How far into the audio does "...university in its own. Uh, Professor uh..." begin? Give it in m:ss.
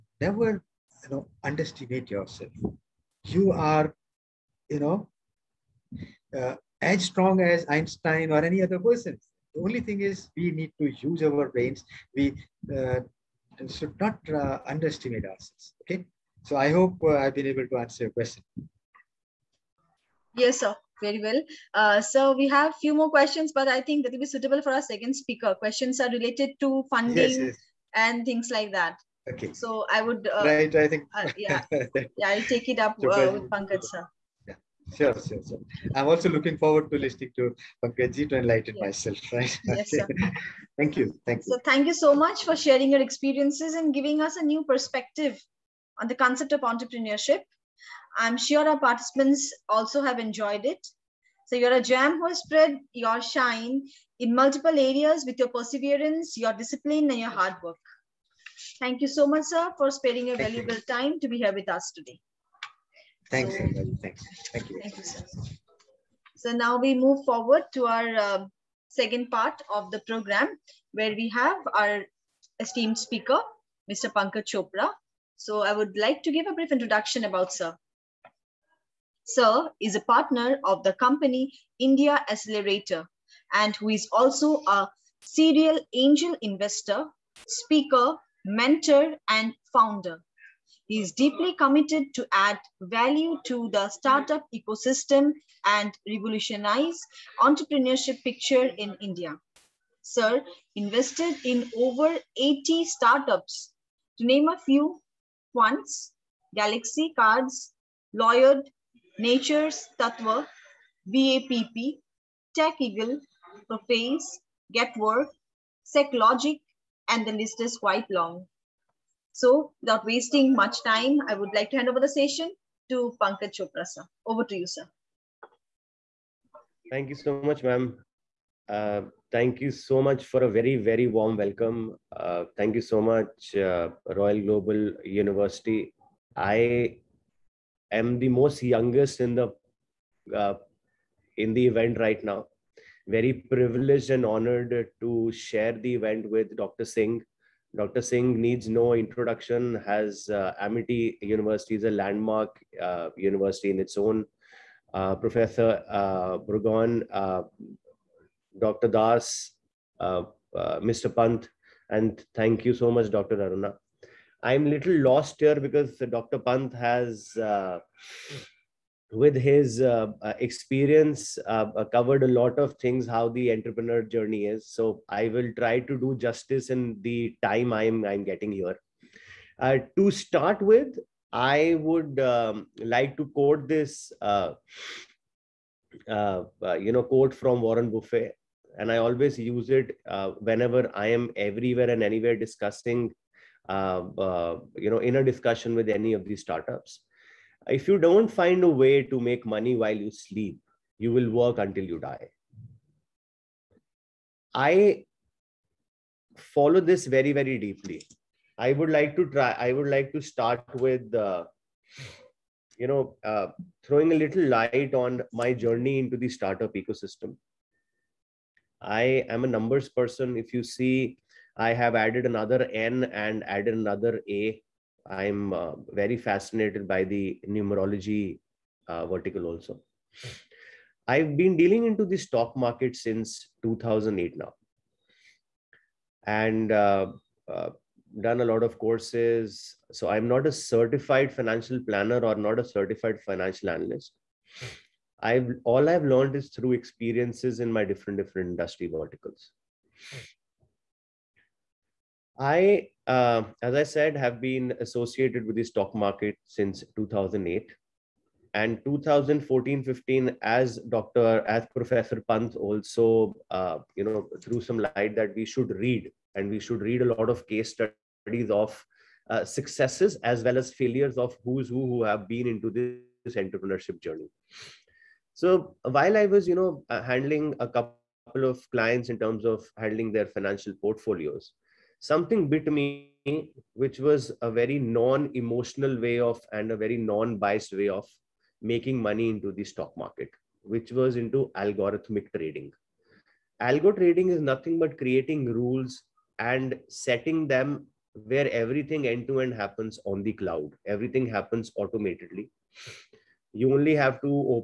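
2:33.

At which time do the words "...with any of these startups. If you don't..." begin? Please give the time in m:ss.
3:15.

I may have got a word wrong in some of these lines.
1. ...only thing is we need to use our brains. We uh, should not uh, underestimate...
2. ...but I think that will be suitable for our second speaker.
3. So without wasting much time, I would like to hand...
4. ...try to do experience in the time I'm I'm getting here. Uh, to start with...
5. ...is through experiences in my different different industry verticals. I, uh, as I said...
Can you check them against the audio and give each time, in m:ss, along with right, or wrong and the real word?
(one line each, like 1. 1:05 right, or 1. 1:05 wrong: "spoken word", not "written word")
1. 0:09 right
2. 0:23 right
3. 1:59 right
4. 2:55 wrong: "justice", not "experience"
5. 4:06 right.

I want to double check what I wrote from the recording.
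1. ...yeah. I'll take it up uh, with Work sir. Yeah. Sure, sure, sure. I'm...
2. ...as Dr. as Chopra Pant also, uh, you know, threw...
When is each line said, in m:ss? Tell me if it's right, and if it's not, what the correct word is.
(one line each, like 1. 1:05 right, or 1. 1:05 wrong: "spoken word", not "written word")
1. 0:31 wrong: "Pankaj", not "Work"
2. 4:20 wrong: "Professor", not "Chopra".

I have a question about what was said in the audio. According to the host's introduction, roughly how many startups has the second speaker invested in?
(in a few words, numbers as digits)
over 80.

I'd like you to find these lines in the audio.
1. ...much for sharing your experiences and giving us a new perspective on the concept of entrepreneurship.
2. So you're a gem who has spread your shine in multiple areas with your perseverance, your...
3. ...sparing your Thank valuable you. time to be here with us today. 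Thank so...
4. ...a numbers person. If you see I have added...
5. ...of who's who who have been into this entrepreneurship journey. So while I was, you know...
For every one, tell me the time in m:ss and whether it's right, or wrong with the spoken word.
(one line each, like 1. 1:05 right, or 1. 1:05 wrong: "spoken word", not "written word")
1. 0:42 right
2. 0:51 right
3. 0:59 right
4. 3:39 right
5. 4:31 right.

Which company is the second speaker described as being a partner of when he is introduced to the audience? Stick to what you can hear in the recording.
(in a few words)
India Accelerator.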